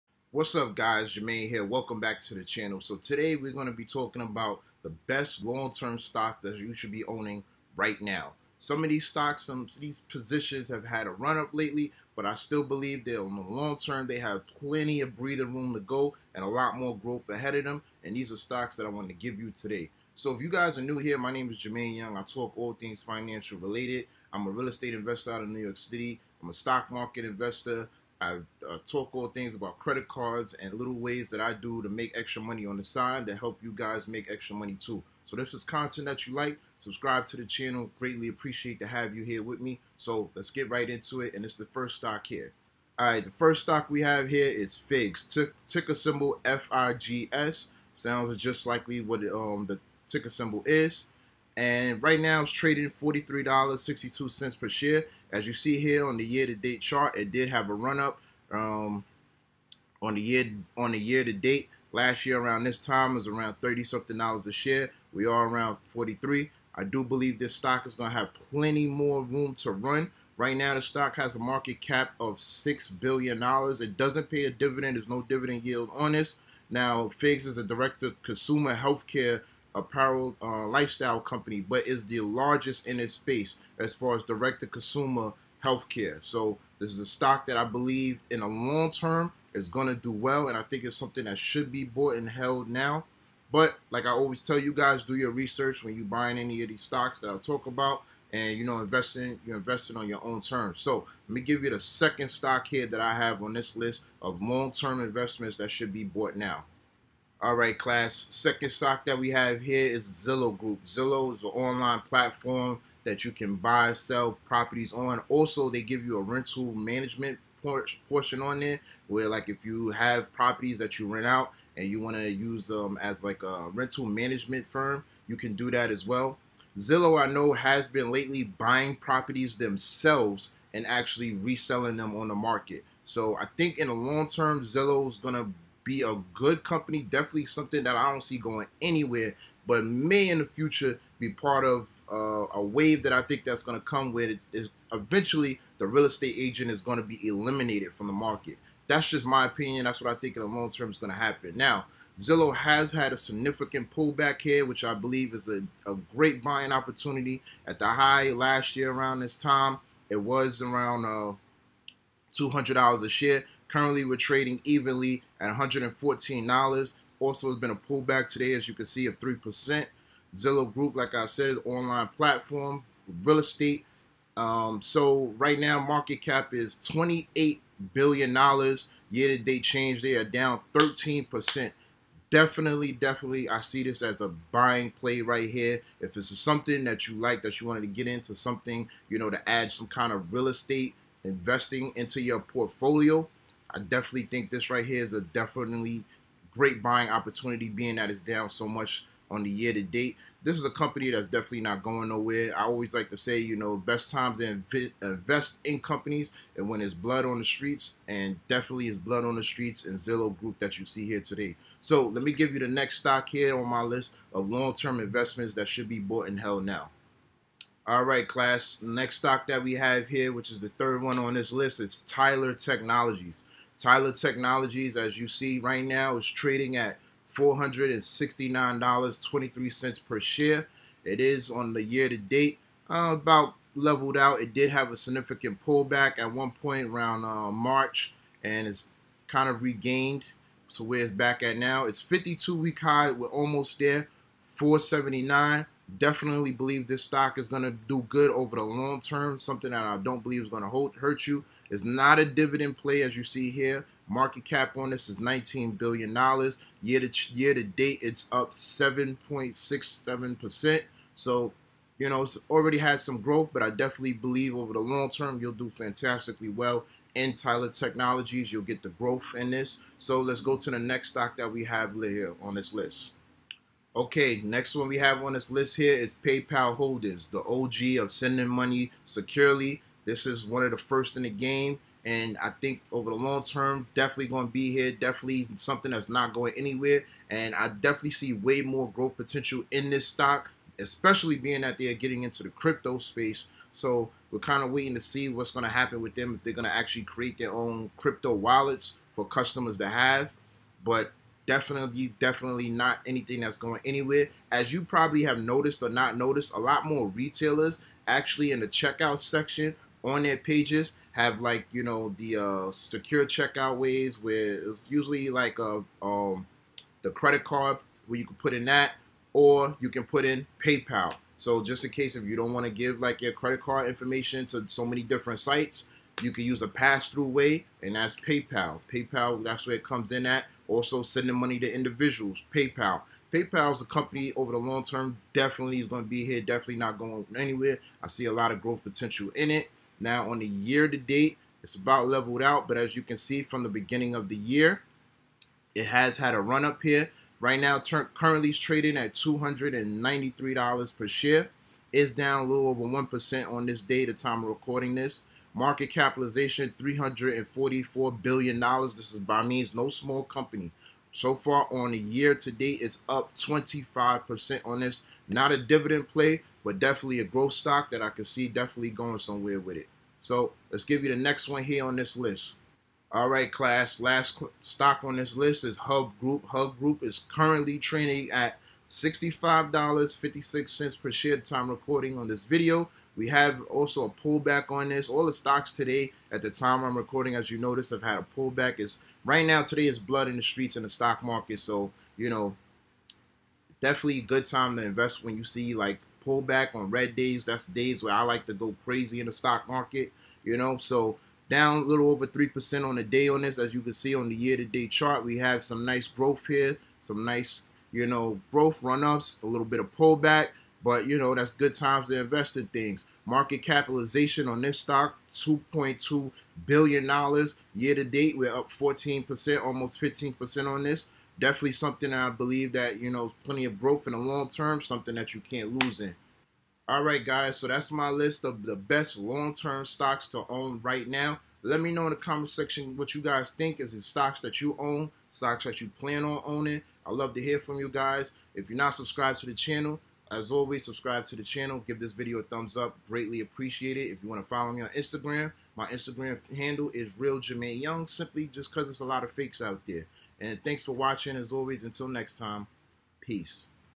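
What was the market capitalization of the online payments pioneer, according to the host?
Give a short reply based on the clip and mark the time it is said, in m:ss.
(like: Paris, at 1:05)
$344 billion, at 5:56.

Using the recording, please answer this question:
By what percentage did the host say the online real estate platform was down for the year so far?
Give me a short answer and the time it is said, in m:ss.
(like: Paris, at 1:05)
13%, at 3:00.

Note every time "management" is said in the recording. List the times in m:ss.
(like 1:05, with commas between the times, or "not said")
1:56, 2:04.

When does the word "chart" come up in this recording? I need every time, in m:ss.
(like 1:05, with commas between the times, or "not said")
0:56, 6:44.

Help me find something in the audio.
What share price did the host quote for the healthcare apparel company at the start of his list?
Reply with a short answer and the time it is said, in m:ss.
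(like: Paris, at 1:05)
$43.62, at 0:53.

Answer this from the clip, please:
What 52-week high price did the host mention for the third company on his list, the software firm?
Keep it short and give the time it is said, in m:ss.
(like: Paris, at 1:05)
479, at 4:04.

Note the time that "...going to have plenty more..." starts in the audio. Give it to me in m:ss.
1:07.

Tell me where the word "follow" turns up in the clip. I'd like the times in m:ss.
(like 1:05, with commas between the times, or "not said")
7:24.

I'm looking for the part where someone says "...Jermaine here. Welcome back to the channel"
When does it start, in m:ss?
0:01.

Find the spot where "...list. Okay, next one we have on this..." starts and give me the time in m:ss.
4:32.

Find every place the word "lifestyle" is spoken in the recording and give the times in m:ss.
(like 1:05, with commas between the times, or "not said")
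1:20.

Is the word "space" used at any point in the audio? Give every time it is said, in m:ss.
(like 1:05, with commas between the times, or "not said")
1:23, 4:52.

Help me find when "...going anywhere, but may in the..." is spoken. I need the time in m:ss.
2:18.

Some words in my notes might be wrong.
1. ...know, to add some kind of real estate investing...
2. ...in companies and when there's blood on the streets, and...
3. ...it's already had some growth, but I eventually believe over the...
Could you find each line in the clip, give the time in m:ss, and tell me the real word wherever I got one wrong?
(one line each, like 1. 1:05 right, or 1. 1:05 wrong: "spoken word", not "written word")
1. 3:09 right
2. 3:25 right
3. 4:22 wrong: "definitely", not "eventually".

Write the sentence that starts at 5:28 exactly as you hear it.
PayPal, that's where it comes in at.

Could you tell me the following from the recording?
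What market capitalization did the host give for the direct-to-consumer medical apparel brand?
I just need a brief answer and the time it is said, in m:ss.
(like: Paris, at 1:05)
6 billion dollars, at 1:12.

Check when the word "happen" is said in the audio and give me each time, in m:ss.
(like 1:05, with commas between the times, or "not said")
2:31, 4:55.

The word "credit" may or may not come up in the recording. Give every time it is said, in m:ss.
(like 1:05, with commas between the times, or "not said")
0:29, 5:17, 5:23.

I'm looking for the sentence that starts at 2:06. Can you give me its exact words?
Zillow, I know, has been lately buying properties themselves and actually reselling them on the market.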